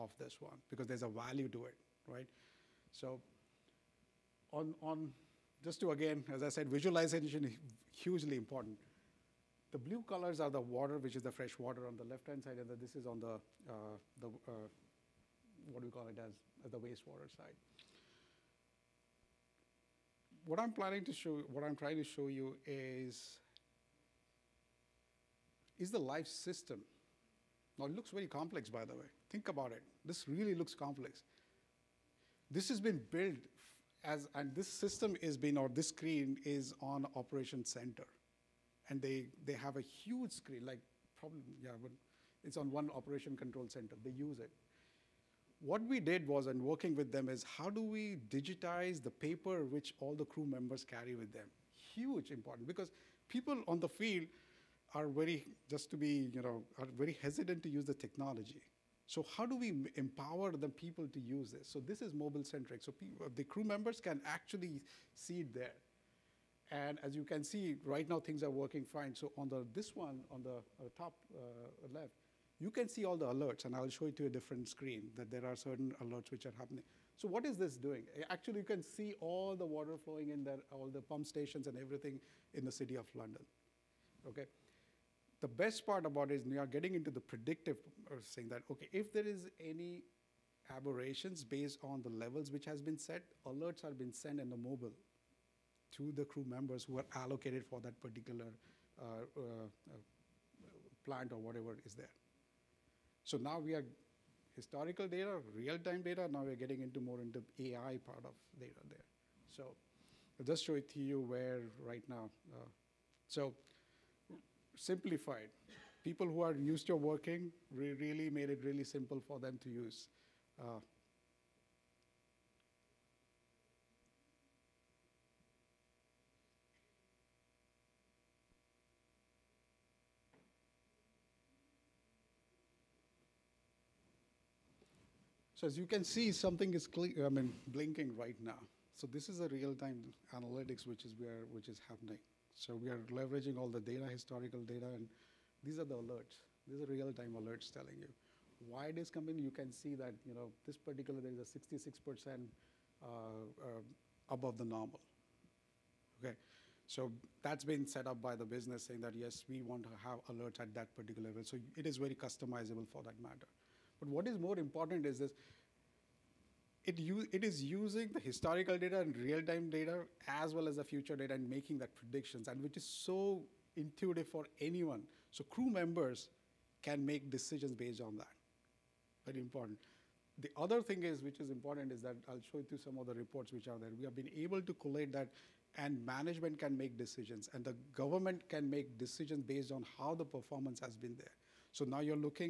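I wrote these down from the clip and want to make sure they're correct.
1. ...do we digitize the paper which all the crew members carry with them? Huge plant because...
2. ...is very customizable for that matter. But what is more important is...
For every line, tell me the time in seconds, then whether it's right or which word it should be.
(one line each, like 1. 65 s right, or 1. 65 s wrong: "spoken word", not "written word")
1. 47 s wrong: "important", not "plant"
2. 161 s right.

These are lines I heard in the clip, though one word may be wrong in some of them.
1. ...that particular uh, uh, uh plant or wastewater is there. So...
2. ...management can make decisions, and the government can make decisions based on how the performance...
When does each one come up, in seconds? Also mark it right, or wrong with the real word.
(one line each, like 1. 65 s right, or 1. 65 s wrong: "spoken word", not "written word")
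1. 97 s wrong: "whatever", not "wastewater"
2. 186 s right.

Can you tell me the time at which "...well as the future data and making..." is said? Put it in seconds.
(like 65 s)
170 s.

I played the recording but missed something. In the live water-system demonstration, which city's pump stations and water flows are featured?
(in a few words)
London.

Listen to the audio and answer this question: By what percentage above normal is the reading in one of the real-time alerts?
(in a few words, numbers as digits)
66%.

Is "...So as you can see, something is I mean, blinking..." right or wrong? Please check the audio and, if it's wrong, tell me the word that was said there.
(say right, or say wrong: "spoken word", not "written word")
right.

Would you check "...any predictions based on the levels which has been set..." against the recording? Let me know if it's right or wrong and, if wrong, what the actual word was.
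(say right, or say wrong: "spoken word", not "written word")
wrong: "aberrations", not "predictions".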